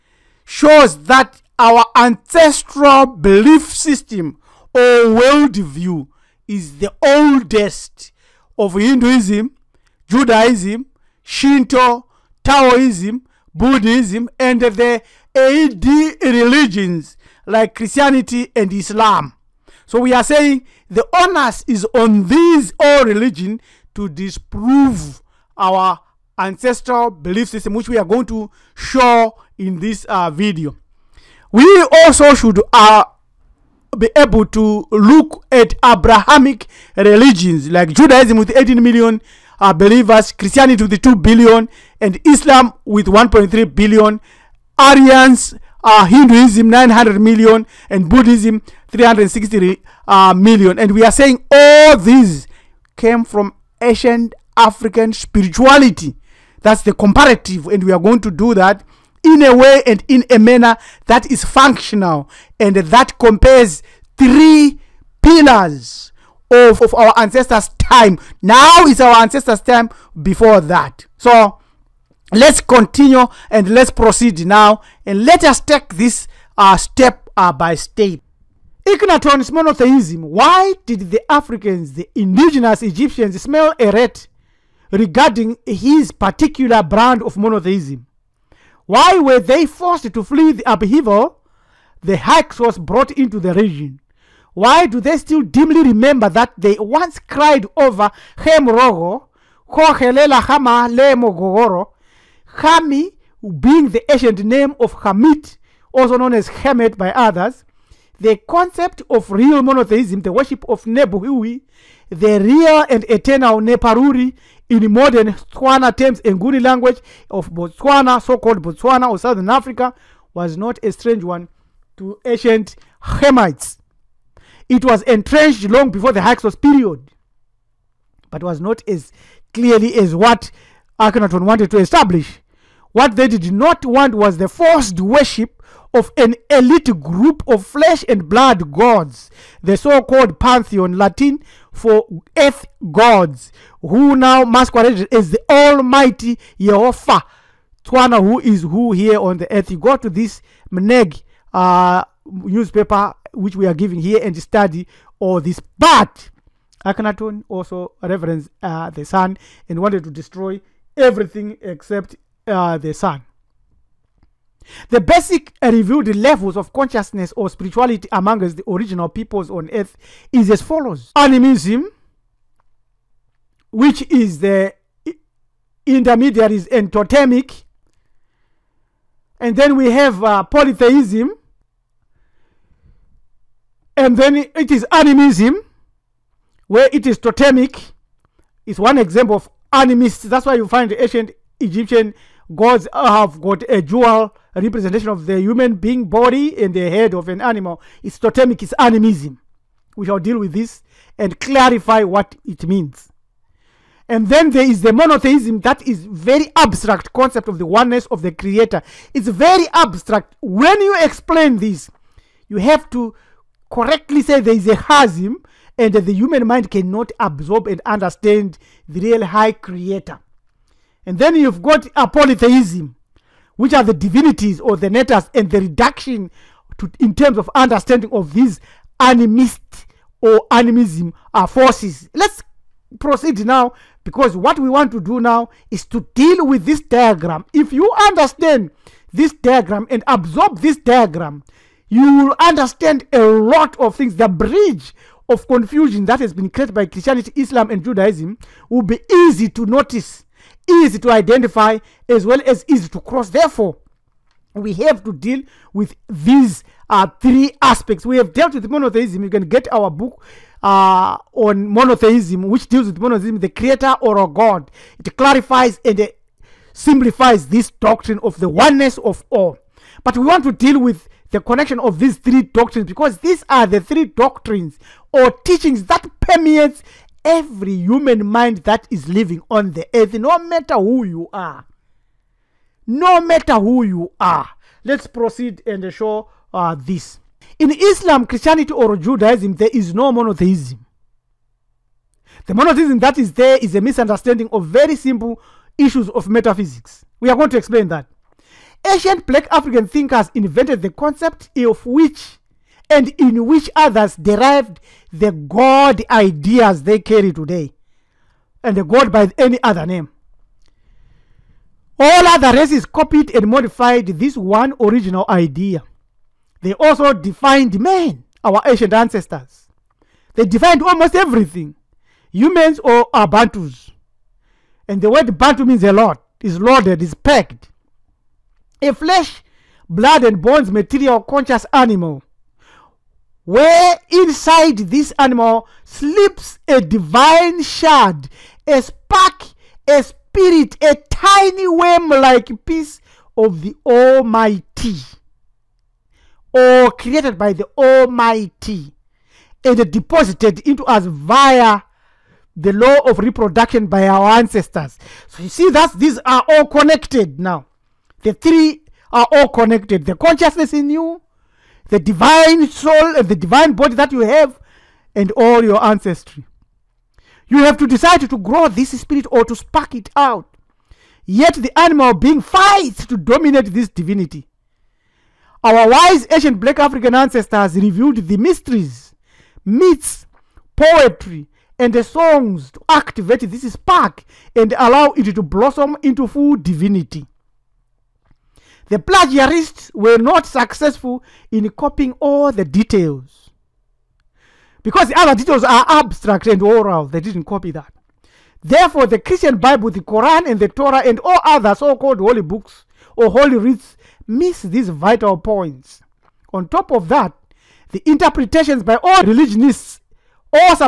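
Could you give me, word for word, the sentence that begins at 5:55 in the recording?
So you see that these are all connected now.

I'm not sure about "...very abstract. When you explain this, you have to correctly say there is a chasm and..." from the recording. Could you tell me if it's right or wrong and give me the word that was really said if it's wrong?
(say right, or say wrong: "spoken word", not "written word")
right.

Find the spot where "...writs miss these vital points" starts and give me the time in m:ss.
6:43.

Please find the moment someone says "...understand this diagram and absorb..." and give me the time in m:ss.
3:58.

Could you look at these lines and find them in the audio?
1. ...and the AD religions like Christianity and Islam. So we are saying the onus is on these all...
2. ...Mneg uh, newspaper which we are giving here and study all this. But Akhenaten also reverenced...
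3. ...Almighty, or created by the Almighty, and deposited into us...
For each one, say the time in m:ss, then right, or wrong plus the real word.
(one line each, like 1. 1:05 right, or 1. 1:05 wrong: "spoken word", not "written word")
1. 0:14 right
2. 2:30 right
3. 5:43 right.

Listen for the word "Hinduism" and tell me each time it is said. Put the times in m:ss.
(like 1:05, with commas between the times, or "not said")
0:08, 0:46.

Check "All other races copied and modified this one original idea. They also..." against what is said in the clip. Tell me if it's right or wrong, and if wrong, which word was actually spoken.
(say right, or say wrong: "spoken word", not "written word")
right.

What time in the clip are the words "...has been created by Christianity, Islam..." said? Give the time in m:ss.
4:06.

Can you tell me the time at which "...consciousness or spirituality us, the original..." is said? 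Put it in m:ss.
2:46.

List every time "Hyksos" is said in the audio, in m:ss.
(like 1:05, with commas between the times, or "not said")
1:32, 2:06.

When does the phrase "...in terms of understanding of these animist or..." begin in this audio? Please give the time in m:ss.
3:46.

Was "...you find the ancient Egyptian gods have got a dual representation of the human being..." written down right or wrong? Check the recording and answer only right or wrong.
right.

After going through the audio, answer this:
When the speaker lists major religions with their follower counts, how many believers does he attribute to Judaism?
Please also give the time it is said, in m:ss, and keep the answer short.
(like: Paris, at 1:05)
18 million, at 0:38.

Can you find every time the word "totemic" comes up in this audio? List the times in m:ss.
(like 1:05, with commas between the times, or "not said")
2:56, 3:07, 3:18.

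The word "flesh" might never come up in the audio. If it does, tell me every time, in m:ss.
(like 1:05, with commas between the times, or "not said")
2:17, 5:28.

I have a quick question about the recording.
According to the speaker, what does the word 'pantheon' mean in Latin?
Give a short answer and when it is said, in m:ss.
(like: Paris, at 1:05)
earth gods, at 2:22.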